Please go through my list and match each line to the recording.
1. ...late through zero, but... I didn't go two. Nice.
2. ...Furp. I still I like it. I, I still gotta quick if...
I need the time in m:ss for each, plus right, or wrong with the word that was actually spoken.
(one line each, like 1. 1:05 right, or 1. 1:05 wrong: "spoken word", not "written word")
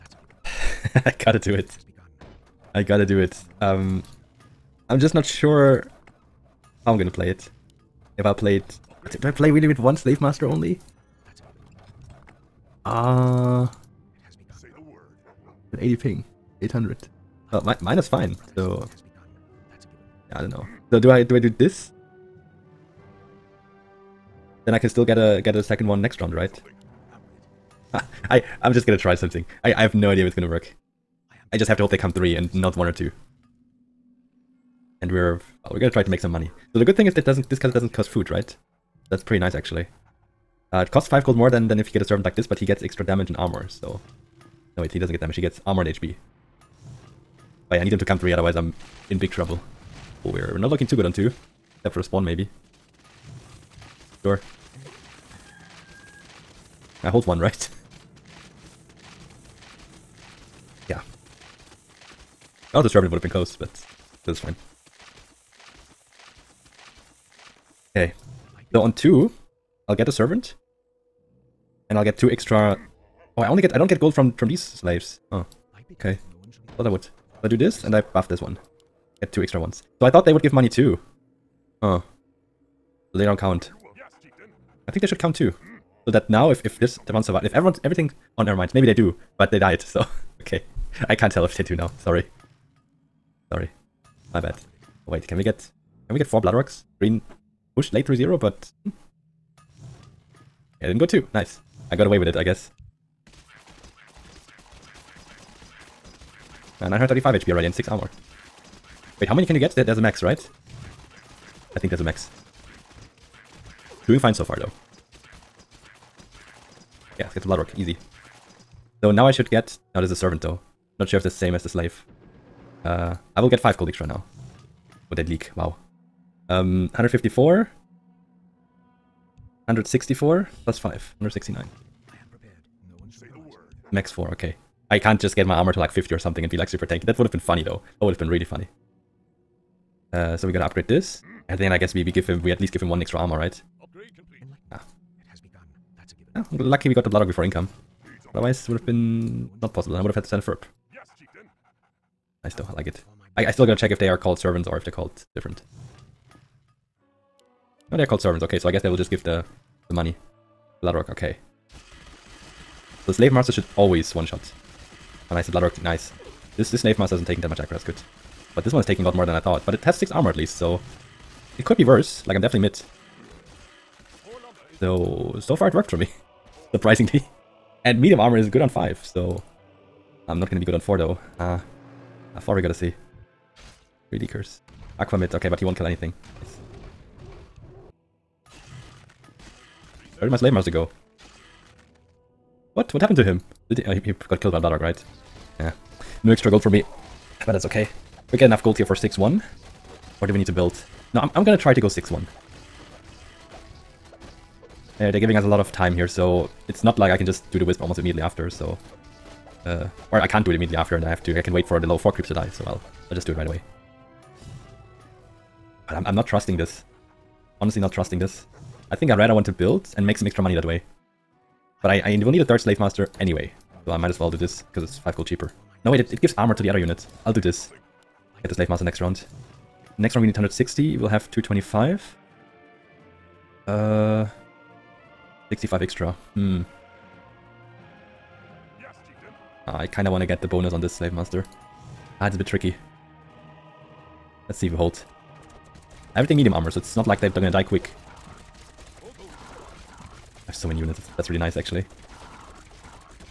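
1. 1:37 right
2. 2:30 wrong: "check", not "quick".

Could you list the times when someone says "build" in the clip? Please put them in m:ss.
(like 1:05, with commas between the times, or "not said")
3:20, 3:39.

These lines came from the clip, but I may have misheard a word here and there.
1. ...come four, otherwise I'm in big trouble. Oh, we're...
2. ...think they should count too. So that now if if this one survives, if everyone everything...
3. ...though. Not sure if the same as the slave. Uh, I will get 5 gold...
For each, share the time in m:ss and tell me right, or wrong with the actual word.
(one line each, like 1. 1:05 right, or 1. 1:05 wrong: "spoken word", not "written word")
1. 0:48 wrong: "three", not "four"
2. 1:24 right
3. 2:00 right.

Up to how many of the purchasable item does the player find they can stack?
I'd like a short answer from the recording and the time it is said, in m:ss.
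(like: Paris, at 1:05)
4, at 2:13.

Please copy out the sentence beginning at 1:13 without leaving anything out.
Oh, I only get I don't get gold from from these slaves.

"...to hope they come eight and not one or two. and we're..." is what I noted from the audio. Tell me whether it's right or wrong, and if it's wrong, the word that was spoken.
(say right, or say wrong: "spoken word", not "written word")
wrong: "three", not "eight".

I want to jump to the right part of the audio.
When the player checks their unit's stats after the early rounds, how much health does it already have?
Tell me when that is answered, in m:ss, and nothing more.
1:46.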